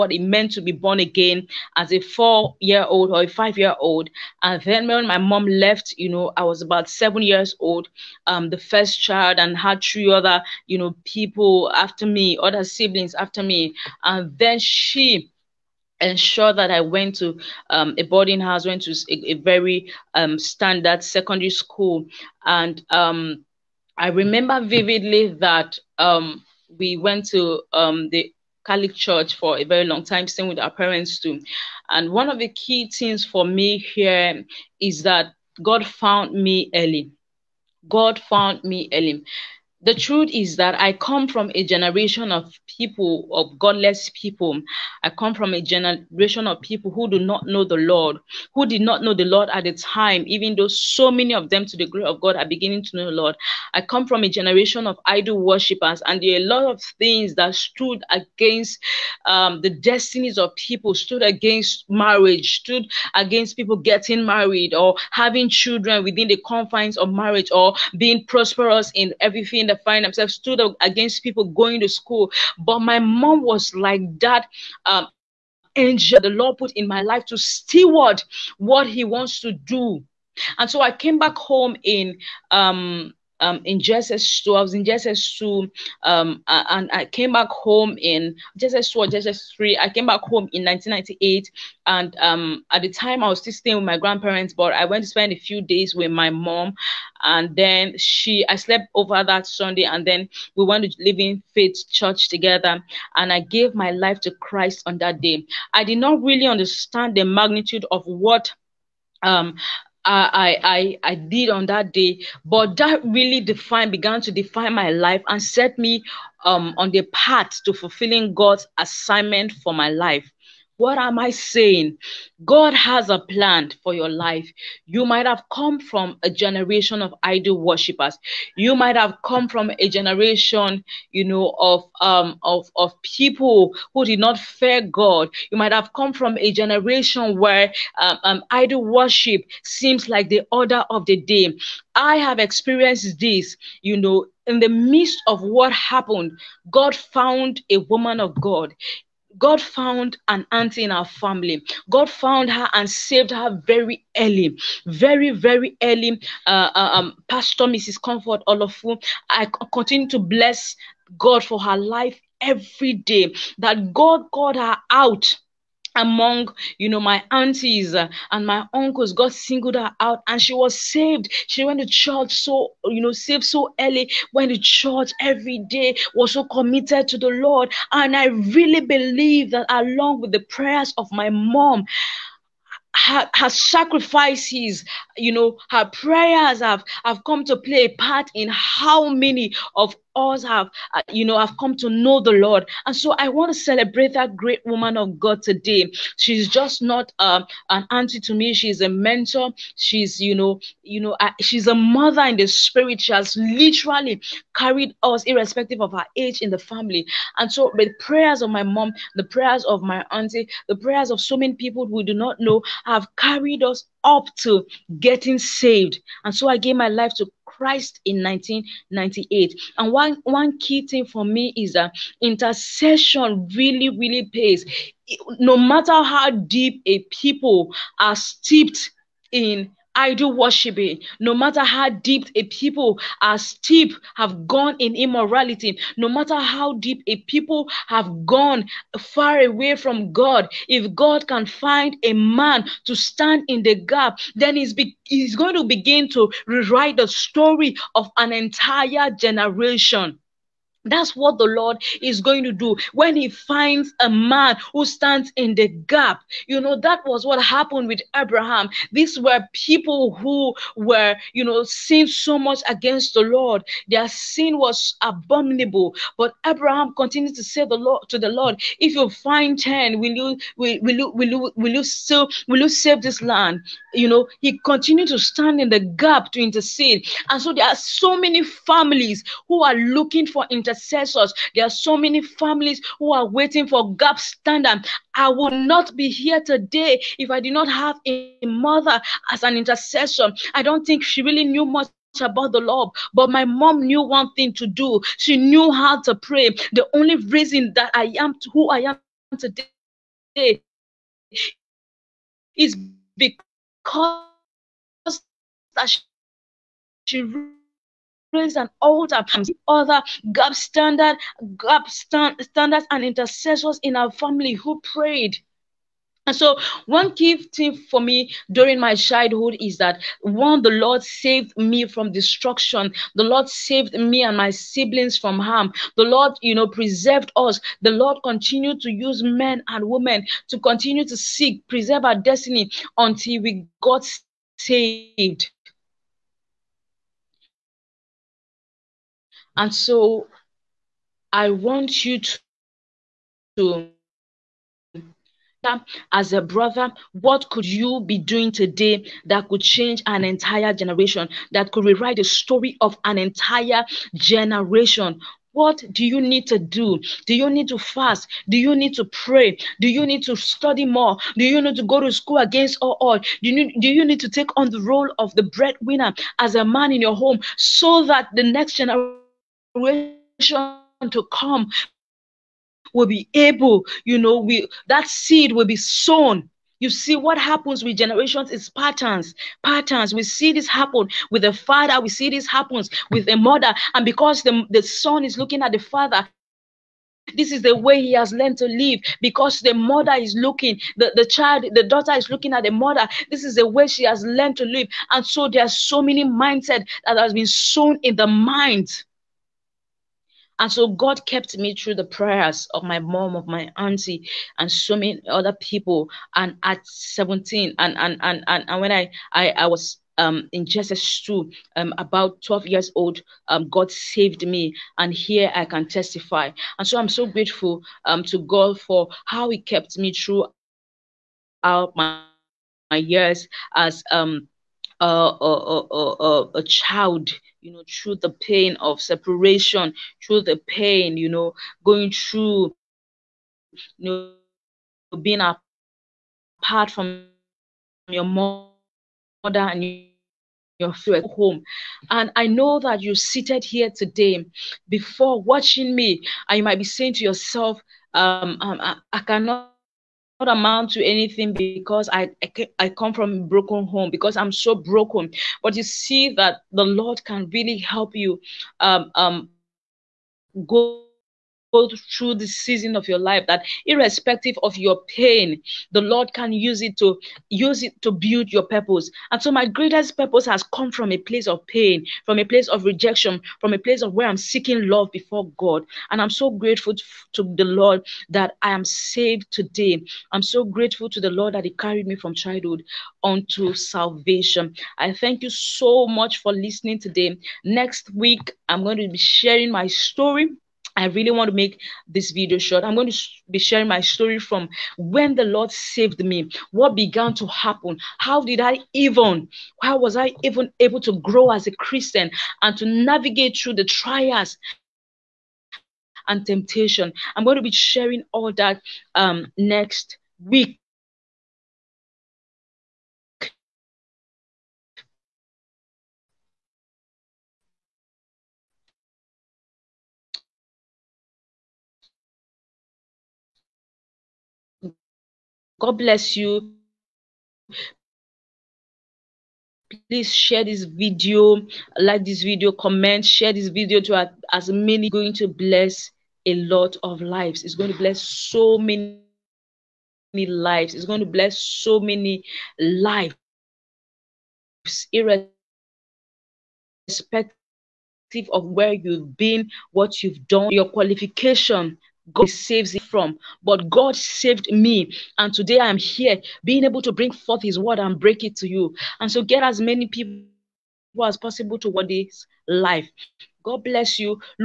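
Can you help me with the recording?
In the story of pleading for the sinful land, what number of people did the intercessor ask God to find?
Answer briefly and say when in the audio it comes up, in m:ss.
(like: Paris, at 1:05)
10, at 4:29.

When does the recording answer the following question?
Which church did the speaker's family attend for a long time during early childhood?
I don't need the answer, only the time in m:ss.
0:28.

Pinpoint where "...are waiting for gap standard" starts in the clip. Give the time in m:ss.
4:43.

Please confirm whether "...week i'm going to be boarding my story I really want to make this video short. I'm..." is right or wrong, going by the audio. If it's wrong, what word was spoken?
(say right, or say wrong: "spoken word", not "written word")
wrong: "sharing", not "boarding".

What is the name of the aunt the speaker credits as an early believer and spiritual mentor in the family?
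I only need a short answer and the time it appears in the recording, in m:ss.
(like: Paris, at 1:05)
Pastor Mrs. Comfort, at 2:37.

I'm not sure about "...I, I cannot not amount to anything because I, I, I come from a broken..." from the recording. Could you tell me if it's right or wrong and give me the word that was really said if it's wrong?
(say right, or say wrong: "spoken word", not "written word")
right.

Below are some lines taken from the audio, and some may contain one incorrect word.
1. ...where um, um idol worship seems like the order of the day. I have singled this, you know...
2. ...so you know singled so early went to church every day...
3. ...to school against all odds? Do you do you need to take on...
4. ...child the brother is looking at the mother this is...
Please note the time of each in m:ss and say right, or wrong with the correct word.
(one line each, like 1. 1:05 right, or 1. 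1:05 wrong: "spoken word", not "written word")
1. 2:17 wrong: "experienced", not "singled"
2. 2:52 wrong: "saved", not "singled"
3. 6:01 right
4. 6:31 wrong: "daughter", not "brother".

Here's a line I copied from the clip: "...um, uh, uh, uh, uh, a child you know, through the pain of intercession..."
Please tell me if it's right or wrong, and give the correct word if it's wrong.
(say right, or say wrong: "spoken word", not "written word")
wrong: "separation", not "intercession".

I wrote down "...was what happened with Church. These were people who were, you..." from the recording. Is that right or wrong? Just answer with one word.
wrong.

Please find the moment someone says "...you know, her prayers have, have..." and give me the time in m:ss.
3:05.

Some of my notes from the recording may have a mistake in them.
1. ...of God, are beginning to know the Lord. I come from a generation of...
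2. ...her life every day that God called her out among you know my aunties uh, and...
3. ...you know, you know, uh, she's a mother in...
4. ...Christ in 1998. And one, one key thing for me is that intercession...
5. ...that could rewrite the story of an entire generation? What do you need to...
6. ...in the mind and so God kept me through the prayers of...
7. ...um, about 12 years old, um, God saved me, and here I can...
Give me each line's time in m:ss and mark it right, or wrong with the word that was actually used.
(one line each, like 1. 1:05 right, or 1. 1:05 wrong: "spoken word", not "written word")
1. 0:52 right
2. 2:41 right
3. 3:20 right
4. 3:37 right
5. 5:51 right
6. 6:38 right
7. 6:51 right.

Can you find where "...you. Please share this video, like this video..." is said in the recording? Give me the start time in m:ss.
8:46.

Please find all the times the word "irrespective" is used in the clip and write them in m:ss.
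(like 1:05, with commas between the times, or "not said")
3:25, 7:43, 9:05.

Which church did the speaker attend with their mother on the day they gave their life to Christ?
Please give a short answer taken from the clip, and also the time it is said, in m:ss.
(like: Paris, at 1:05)
Living Faith Church, at 1:41.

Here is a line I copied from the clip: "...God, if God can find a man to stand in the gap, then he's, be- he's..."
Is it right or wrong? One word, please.
right.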